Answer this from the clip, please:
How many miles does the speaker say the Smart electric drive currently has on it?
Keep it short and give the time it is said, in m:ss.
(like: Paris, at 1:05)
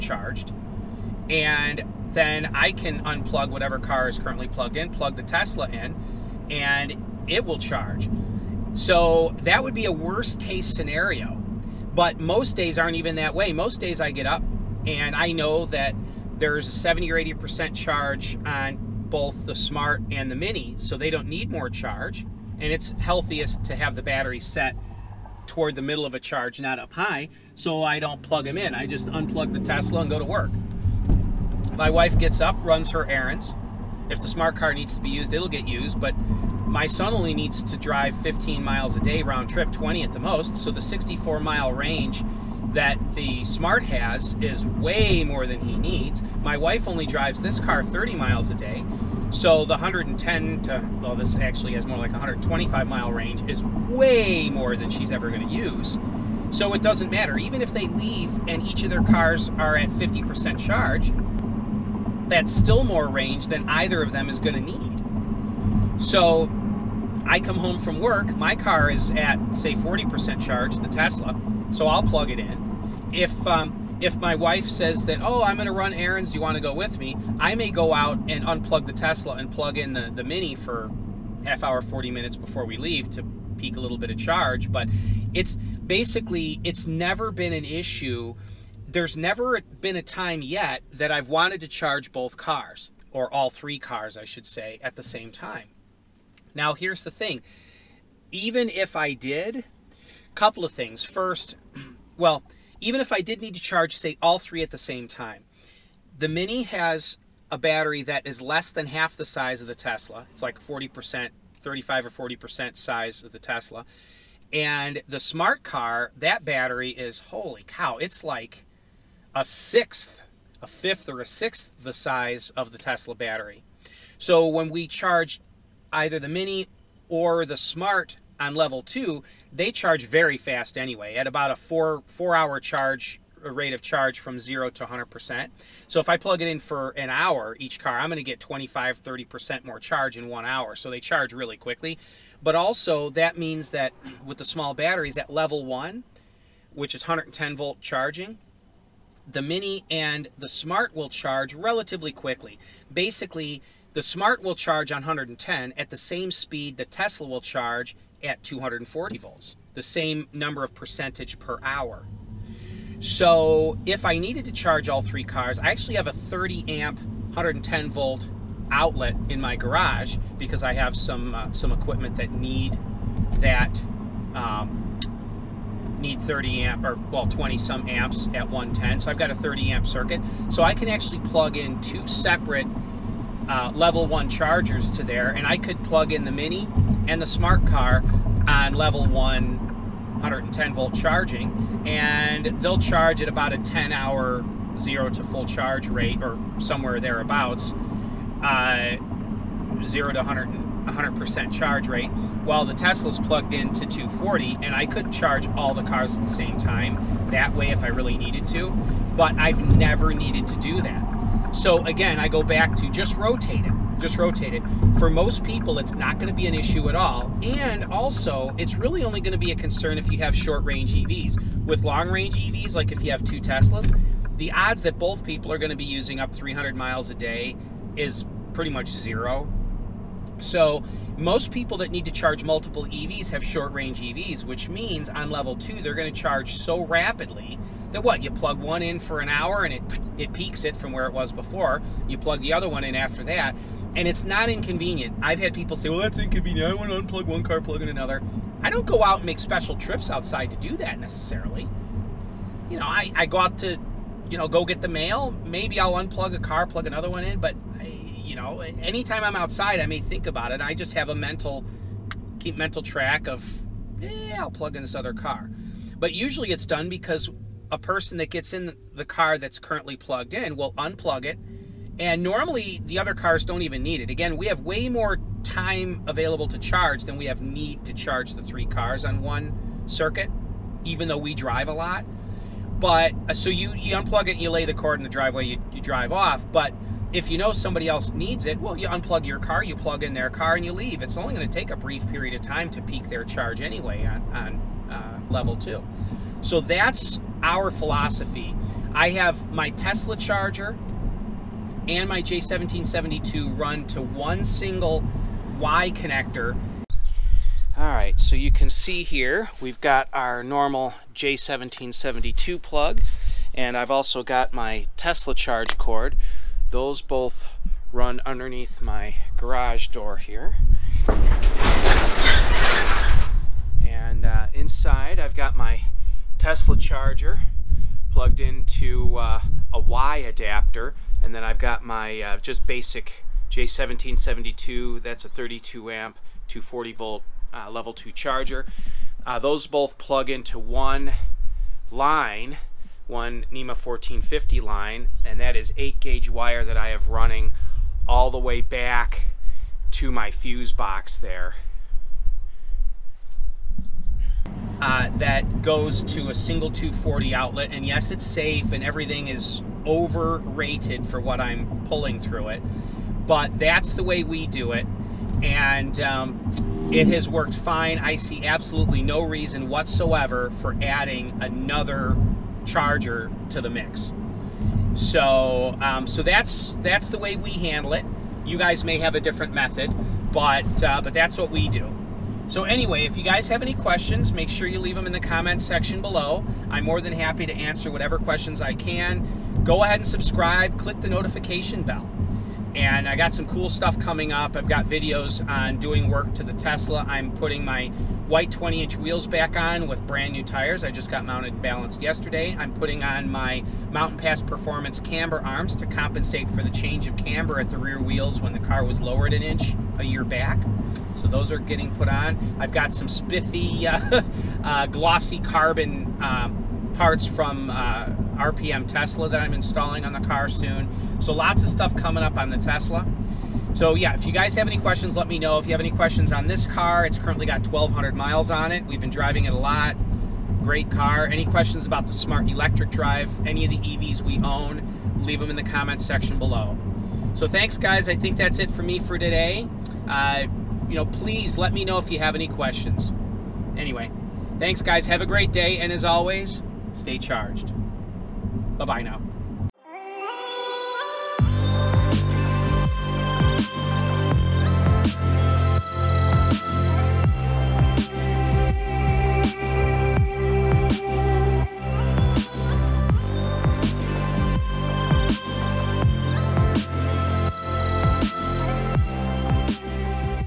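1,200, at 7:07.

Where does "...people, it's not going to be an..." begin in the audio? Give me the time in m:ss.
3:35.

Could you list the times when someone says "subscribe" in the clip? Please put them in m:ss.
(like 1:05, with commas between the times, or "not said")
6:30.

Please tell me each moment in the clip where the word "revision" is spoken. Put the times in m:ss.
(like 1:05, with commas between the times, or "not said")
not said.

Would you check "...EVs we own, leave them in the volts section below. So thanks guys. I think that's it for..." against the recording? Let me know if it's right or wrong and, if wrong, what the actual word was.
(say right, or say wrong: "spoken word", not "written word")
wrong: "comments", not "volts".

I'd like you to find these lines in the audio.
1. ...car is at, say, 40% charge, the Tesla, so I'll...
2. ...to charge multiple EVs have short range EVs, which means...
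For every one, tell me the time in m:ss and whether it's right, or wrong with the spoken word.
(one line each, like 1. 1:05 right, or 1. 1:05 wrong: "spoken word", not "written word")
1. 1:08 right
2. 3:52 right.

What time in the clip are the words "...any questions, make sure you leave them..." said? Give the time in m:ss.
6:23.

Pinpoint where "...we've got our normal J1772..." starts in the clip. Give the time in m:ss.
5:09.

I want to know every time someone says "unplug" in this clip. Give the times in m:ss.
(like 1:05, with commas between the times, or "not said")
0:03, 0:29, 1:18, 4:07, 4:15, 4:30, 4:43, 4:48.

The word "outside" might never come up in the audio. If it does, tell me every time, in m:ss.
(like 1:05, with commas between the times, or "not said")
4:10, 4:19.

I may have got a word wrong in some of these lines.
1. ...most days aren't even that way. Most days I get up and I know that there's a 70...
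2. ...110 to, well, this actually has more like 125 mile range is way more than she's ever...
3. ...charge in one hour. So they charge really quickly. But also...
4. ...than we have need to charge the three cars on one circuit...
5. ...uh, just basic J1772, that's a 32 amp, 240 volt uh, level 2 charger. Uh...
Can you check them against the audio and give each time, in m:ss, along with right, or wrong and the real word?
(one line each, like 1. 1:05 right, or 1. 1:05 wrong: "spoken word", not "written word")
1. 0:12 right
2. 0:49 right
3. 2:19 right
4. 4:37 right
5. 5:32 right.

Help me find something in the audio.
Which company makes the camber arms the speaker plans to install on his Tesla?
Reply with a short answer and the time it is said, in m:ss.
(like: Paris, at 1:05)
Mountain Pass Performance, at 6:43.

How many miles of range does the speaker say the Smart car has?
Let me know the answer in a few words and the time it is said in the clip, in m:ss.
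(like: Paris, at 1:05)
64, at 0:40.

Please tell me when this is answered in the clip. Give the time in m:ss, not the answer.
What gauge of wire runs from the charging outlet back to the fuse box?
5:45.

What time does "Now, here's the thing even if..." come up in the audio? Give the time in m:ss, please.
1:36.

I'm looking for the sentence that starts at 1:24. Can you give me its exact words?
But it's basically, it's never been an issue.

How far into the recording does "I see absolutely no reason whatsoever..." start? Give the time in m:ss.
6:07.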